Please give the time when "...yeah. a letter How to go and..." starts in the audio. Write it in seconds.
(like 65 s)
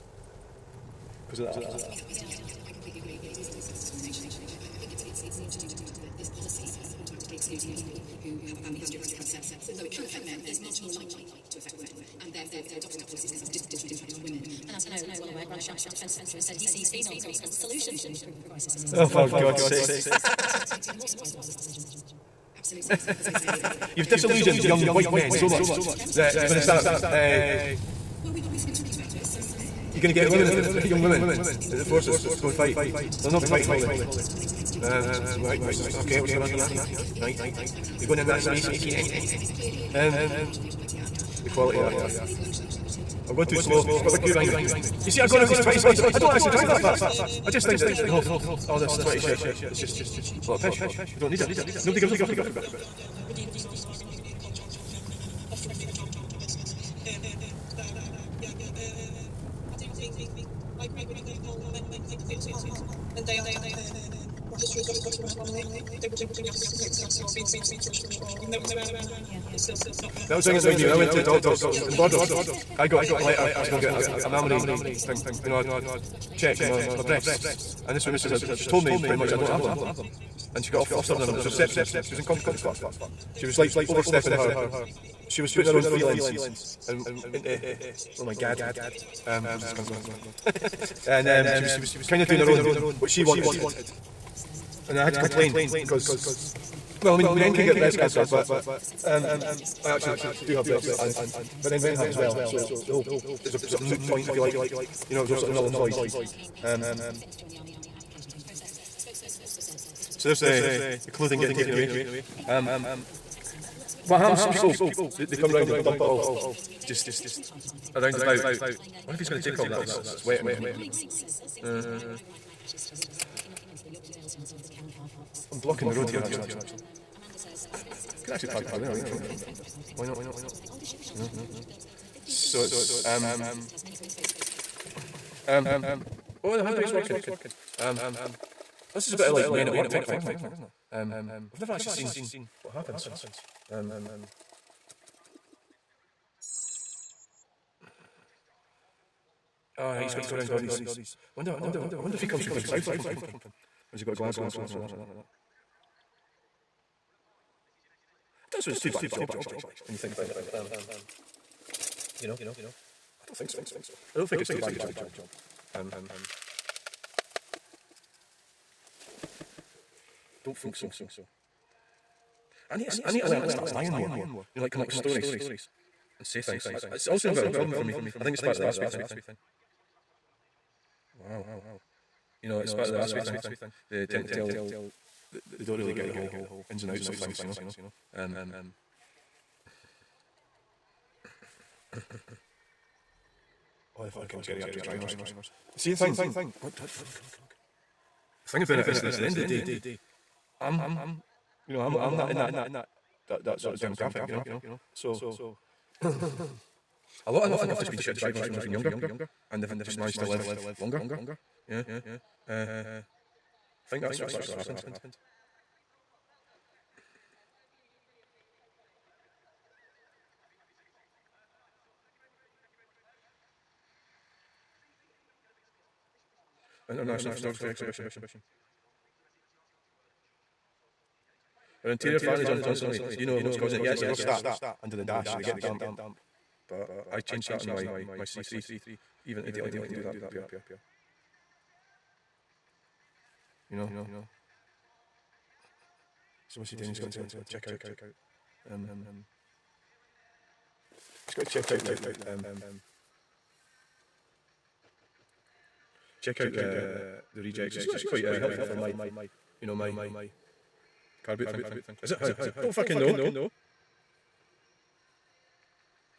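73 s.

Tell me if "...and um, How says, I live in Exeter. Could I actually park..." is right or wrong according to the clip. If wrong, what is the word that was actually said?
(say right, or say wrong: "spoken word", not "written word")
wrong: "Amanda", not "How".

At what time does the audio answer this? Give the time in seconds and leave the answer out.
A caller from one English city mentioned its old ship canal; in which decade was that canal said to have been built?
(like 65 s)
132 s.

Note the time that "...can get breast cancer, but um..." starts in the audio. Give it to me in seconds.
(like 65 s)
97 s.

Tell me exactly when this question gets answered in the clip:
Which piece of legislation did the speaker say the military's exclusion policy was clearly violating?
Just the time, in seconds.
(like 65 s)
40 s.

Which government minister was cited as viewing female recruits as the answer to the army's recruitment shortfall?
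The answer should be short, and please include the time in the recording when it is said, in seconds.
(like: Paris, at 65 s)
Grant Shapps, at 15 s.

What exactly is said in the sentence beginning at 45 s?
You see, I'm going over these 20s I don't actually drive that fast.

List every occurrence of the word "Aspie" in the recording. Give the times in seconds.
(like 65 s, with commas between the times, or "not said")
178 s, 182 s.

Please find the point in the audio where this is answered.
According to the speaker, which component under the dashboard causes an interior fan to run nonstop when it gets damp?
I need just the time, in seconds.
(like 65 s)
234 s.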